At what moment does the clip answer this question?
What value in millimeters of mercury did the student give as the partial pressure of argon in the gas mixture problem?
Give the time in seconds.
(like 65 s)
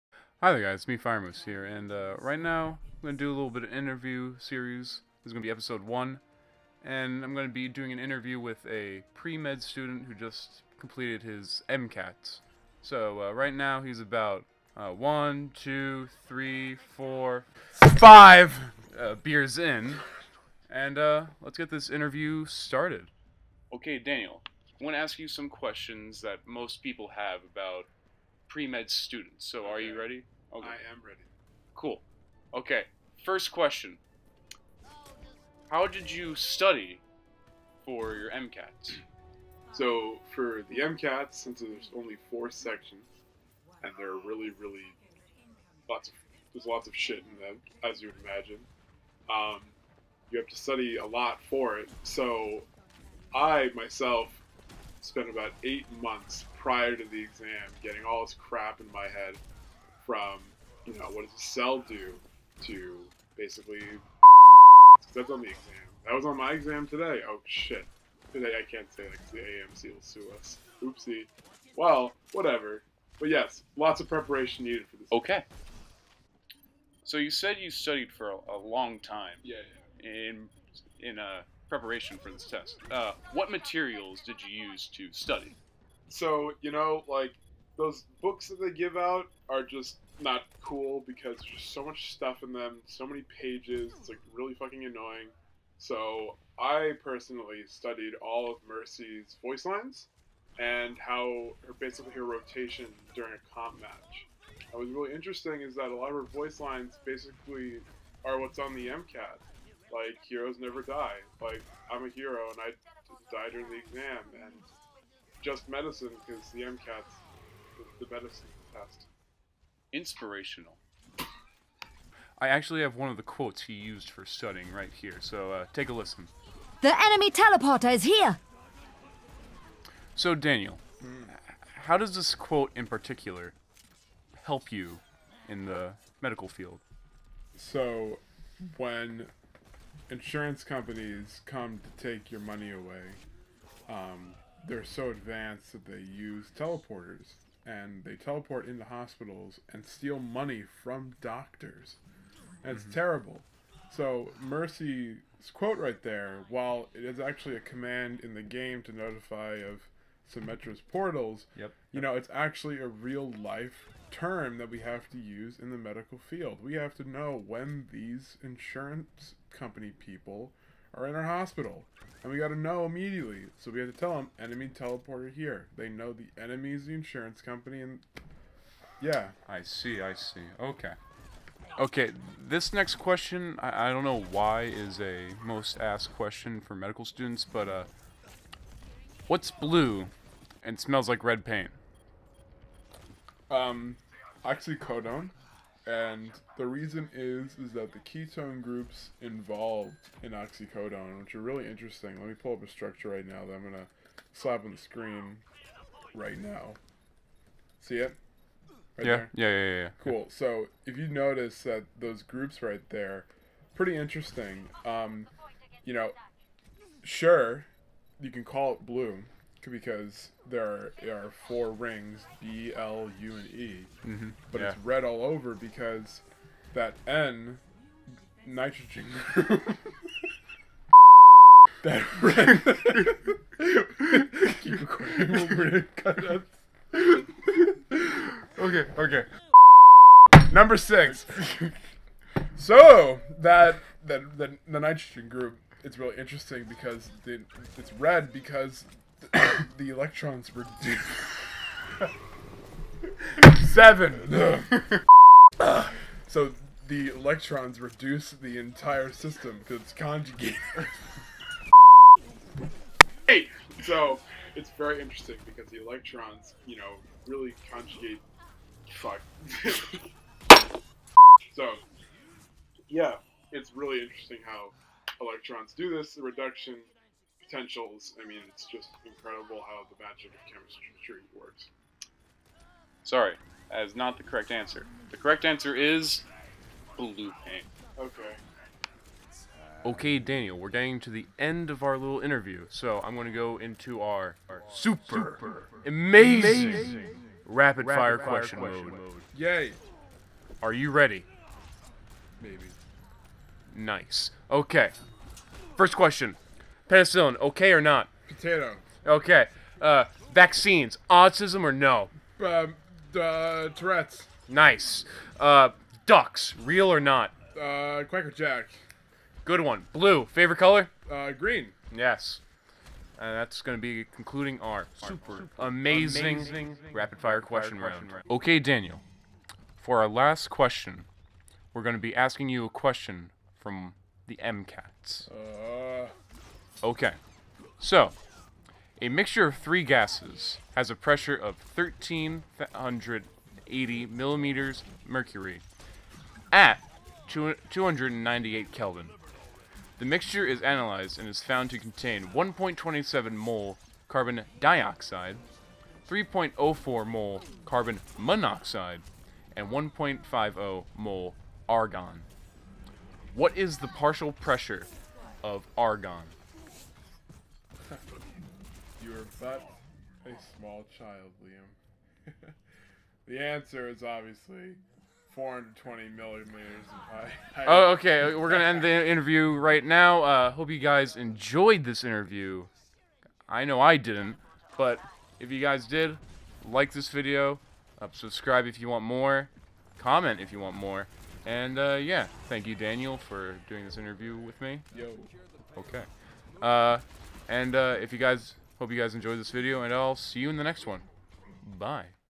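375 s.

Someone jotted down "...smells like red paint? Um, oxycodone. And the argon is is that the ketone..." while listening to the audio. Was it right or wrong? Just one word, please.
wrong.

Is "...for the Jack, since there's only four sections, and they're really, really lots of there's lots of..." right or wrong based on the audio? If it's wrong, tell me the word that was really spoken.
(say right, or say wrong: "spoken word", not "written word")
wrong: "MCATs", not "Jack".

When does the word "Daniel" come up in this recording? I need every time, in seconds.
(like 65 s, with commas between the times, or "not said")
23 s, 130 s, 290 s, 328 s, 392 s.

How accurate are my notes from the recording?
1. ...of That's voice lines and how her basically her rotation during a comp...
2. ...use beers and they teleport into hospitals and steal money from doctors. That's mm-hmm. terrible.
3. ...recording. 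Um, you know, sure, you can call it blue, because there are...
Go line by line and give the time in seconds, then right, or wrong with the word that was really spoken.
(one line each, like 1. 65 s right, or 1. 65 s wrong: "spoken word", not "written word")
1. 98 s wrong: "Mercy", not "That"
2. 145 s wrong: "teleporters", not "beers"
3. 213 s wrong: "interesting", not "recording".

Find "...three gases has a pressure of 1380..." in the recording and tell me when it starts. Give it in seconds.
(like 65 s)
339 s.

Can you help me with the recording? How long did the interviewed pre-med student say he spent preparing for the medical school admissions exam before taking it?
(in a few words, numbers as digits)
8 months.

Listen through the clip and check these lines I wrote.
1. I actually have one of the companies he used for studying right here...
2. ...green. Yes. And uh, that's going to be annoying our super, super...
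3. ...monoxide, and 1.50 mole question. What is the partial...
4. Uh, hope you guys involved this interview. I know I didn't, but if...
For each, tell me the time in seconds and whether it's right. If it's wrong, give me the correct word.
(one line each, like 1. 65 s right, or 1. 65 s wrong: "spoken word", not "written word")
1. 122 s wrong: "quotes", not "companies"
2. 321 s wrong: "concluding", not "annoying"
3. 358 s wrong: "argon", not "question"
4. 380 s wrong: "enjoyed", not "involved".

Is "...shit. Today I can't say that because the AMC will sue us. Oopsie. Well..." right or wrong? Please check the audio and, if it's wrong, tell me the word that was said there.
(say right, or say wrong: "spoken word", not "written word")
right.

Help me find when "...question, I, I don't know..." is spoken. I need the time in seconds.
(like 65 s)
182 s.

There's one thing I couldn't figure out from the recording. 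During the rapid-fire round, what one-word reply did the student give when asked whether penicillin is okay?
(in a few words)
Potato.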